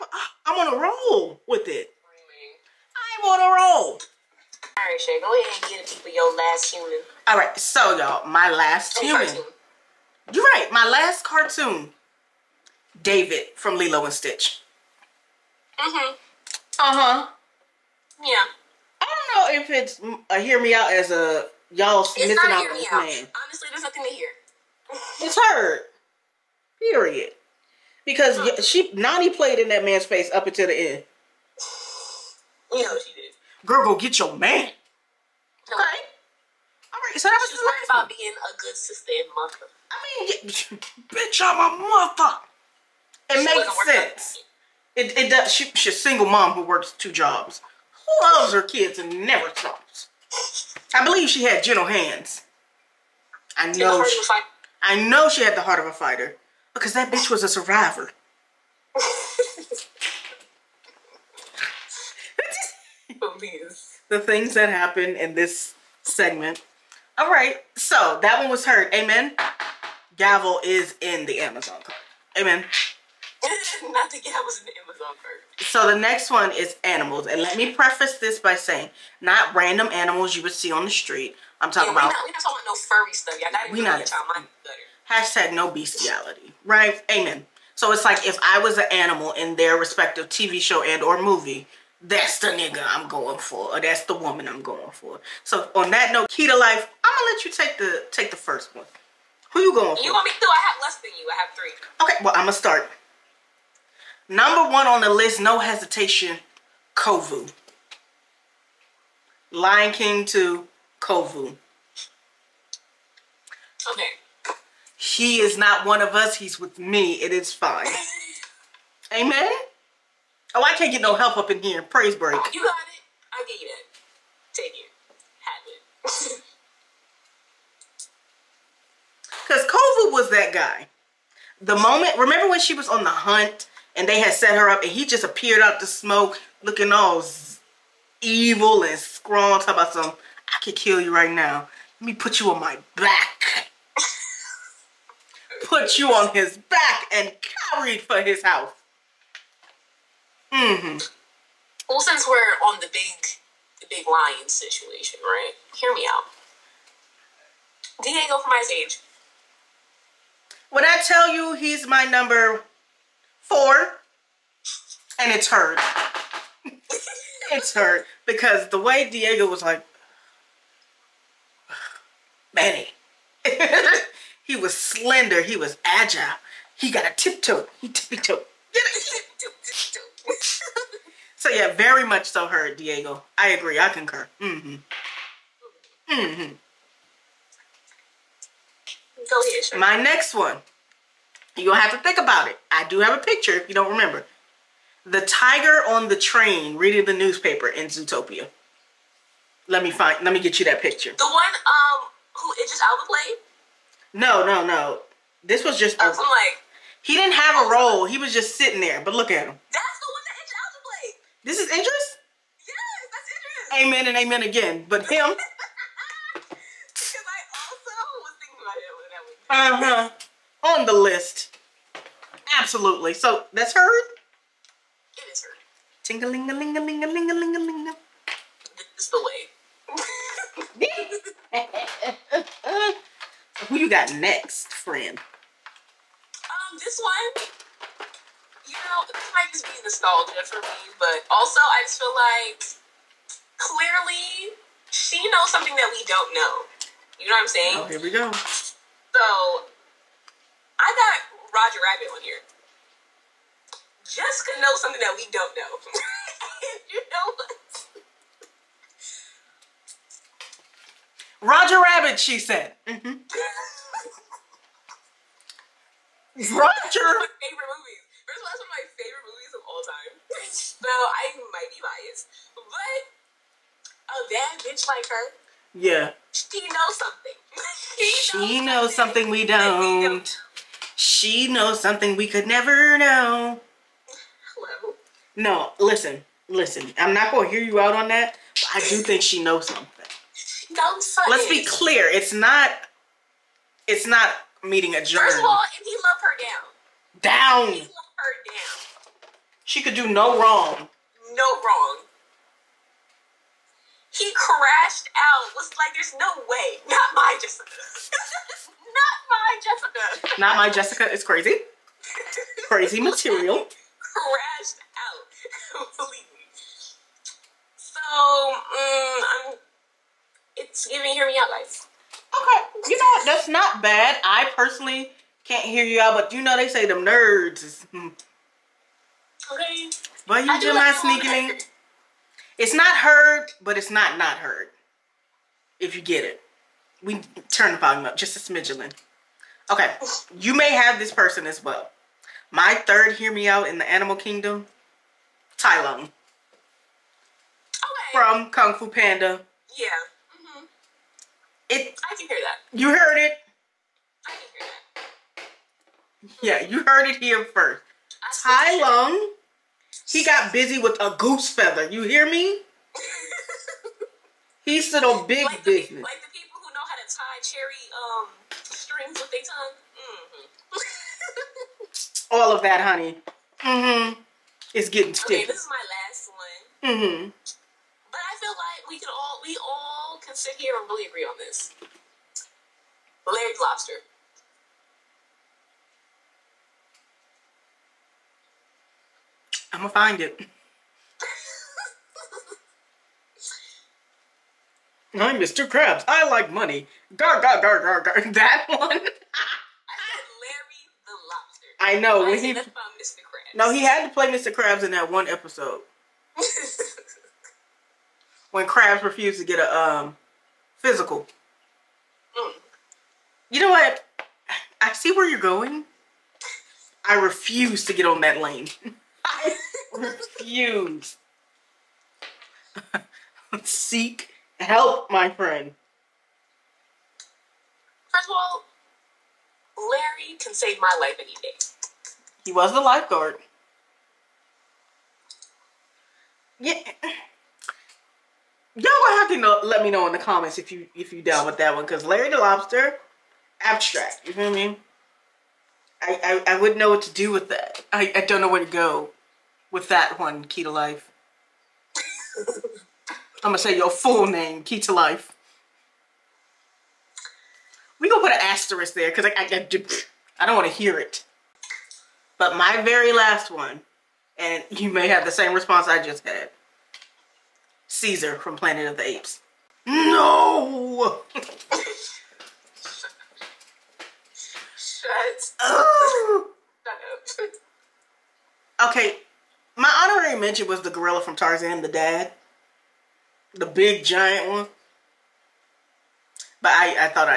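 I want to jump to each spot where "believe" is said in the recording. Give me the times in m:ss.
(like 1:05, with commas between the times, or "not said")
0:51, 5:15.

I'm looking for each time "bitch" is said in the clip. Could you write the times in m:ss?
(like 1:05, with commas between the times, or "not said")
0:41, 0:57, 4:34.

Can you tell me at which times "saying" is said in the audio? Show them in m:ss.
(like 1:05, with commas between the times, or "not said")
1:18, 4:07.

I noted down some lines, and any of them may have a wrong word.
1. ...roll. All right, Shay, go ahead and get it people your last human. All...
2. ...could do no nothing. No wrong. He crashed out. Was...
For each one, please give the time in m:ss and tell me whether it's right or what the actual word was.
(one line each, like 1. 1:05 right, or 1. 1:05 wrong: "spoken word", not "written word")
1. 0:03 right
2. 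4:59 wrong: "wrong", not "nothing".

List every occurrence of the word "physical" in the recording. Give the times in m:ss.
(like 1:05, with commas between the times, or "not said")
6:50.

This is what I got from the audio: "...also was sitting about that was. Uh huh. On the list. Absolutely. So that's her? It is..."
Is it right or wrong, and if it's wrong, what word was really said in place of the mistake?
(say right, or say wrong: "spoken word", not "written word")
wrong: "thinking", not "sitting".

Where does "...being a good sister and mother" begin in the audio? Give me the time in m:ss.
0:38.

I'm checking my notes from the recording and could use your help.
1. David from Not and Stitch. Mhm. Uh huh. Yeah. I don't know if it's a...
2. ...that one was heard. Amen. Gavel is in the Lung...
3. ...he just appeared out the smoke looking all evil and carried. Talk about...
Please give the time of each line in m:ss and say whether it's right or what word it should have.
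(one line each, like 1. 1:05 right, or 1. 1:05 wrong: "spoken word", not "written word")
1. 0:13 wrong: "Lilo", not "Not"
2. 1:08 wrong: "Amazon", not "Lung"
3. 2:14 wrong: "scrawled", not "carried".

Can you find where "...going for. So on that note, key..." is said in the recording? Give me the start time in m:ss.
1:34.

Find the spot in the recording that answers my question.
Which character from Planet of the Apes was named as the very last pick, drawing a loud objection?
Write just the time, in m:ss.
7:47.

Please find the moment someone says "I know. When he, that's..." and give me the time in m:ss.
6:41.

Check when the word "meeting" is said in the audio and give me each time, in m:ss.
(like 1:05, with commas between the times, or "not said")
4:54.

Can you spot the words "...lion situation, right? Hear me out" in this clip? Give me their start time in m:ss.
2:34.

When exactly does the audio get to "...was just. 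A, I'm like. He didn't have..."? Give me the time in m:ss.
3:25.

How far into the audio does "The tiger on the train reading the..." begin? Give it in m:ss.
3:15.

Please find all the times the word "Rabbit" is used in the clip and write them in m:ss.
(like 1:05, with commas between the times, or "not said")
4:11, 4:21.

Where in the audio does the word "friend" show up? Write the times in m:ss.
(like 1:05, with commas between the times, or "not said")
3:54, 7:05.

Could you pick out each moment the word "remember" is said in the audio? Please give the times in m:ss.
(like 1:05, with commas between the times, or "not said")
2:12, 3:13.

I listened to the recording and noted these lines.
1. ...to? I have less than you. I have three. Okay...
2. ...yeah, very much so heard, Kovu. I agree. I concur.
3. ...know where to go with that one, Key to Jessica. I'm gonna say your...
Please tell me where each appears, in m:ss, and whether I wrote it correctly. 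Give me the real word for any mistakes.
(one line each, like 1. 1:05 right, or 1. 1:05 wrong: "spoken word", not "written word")
1. 1:40 right
2. 3:01 wrong: "Diego", not "Kovu"
3. 7:28 wrong: "Life", not "Jessica".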